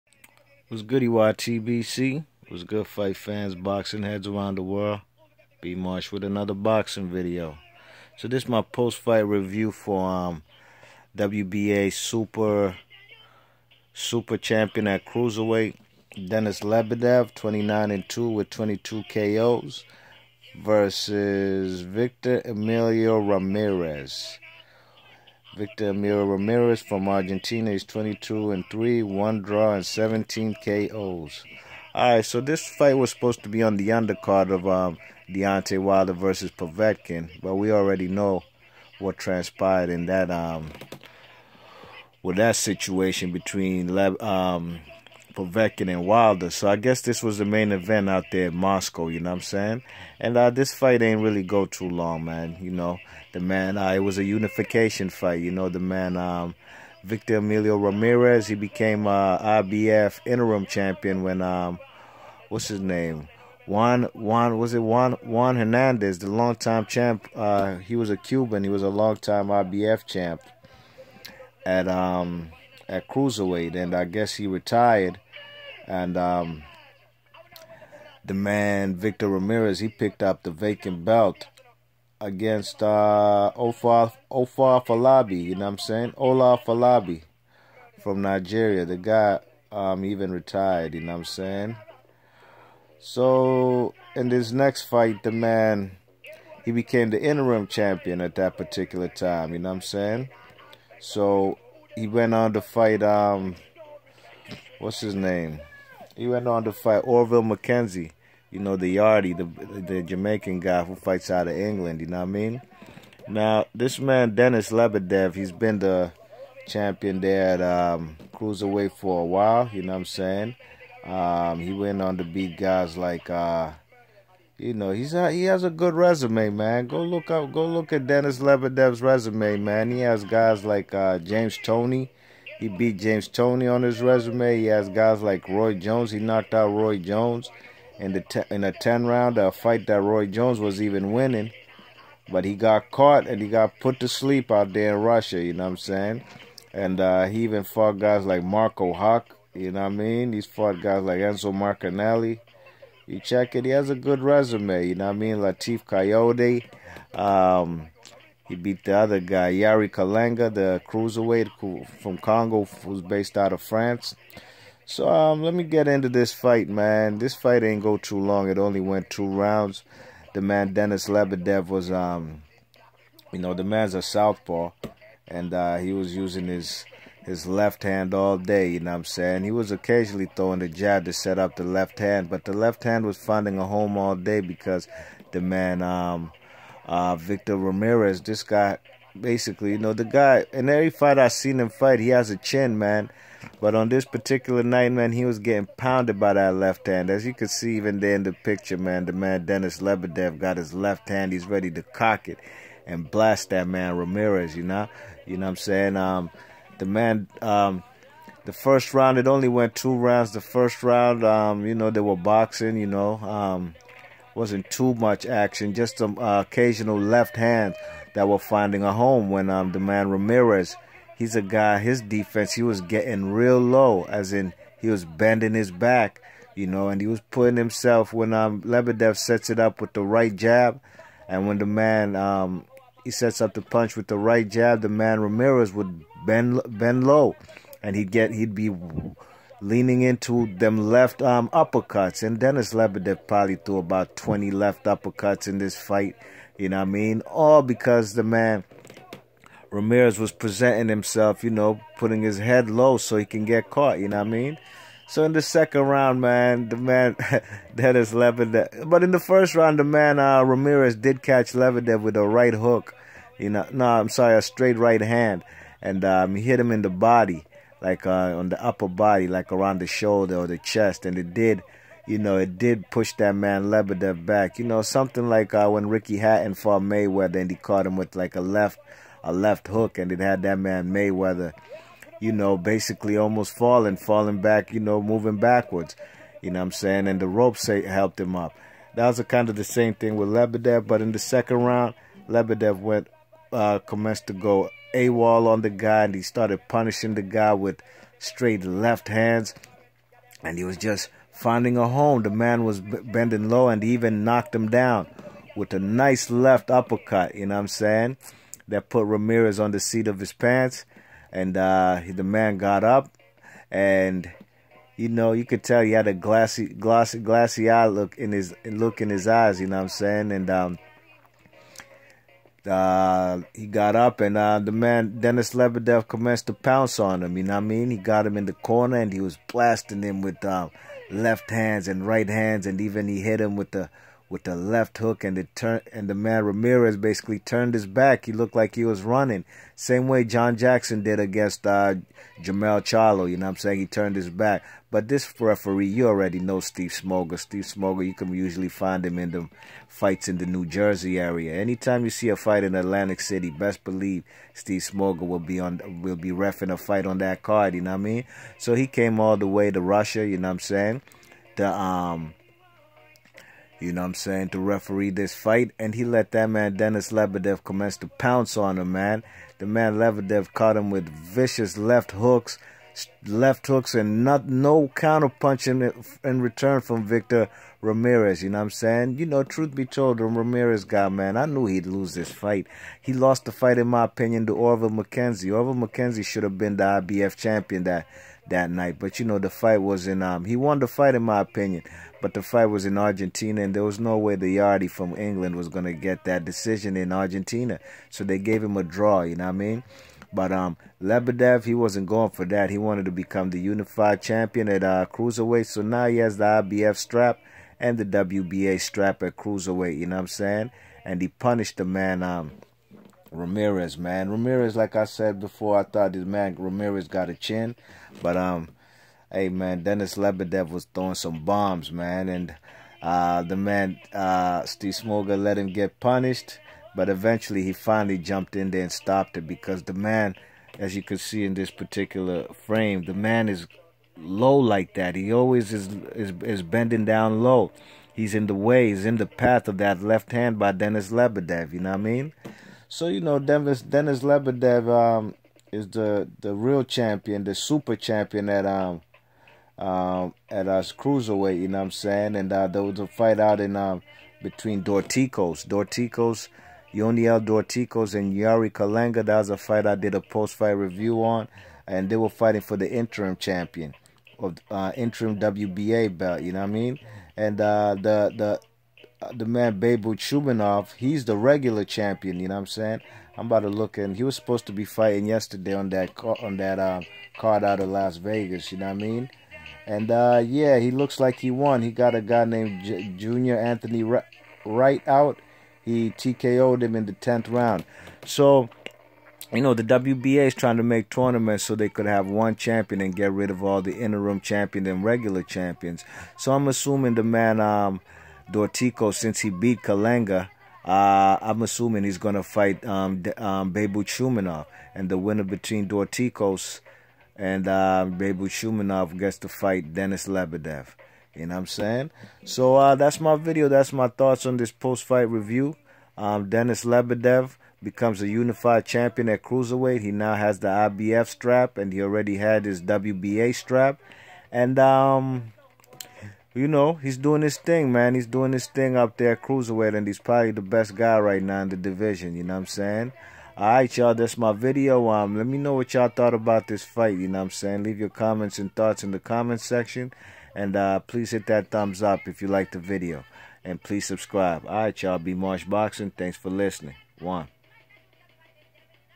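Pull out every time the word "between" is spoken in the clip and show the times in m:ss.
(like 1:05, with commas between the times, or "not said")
0:43, 7:34, 8:25.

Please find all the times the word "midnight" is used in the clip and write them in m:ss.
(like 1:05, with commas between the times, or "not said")
not said.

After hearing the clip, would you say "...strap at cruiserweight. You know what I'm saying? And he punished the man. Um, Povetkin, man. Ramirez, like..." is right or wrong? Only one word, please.
wrong.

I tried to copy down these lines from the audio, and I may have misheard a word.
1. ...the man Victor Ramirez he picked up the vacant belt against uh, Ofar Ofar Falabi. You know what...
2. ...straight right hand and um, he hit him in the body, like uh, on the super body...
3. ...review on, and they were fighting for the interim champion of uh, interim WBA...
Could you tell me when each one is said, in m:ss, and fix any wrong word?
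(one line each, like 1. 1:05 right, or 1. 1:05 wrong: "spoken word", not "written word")
1. 1:18 right
2. 4:24 wrong: "upper", not "super"
3. 7:40 right.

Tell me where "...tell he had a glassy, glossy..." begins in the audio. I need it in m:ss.
5:15.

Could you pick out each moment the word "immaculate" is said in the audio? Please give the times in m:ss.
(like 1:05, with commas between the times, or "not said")
not said.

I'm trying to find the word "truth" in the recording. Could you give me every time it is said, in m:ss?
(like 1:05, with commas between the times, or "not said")
6:19.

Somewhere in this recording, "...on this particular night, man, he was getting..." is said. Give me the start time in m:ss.
3:13.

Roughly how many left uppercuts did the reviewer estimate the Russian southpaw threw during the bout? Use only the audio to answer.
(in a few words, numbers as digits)
20.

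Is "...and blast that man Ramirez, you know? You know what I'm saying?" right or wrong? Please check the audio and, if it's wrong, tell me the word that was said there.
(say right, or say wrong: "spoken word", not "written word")
right.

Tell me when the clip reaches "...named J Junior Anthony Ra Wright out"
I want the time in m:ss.
8:02.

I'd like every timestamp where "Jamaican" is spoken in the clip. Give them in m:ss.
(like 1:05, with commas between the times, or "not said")
1:50.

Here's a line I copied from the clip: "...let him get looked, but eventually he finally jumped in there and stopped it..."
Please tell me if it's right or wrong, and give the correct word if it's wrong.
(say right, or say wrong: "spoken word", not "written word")
wrong: "punished", not "looked".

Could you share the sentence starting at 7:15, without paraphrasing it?
He always is is, is bending down low.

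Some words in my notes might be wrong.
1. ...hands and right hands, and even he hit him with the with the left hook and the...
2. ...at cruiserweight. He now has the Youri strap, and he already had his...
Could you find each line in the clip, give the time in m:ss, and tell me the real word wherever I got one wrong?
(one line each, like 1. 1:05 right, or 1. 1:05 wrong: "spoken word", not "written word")
1. 5:31 right
2. 8:39 wrong: "IBF", not "Youri".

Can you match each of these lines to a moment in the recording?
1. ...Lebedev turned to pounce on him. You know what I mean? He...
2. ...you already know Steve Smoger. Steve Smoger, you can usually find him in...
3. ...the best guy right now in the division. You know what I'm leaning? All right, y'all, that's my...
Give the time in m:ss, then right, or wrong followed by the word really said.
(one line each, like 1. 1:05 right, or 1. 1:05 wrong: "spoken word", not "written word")
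1. 5:25 wrong: "commenced", not "turned"
2. 5:45 right
3. 8:50 wrong: "saying", not "leaning".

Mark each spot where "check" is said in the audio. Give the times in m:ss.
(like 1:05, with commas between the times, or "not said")
2:33.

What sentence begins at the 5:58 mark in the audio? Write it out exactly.
So he came all the way to Russia, you know what I'm saying?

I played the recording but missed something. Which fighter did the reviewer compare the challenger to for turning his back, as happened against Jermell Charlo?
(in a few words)
John Jackson.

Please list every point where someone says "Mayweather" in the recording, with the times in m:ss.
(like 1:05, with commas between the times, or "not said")
4:36, 4:40.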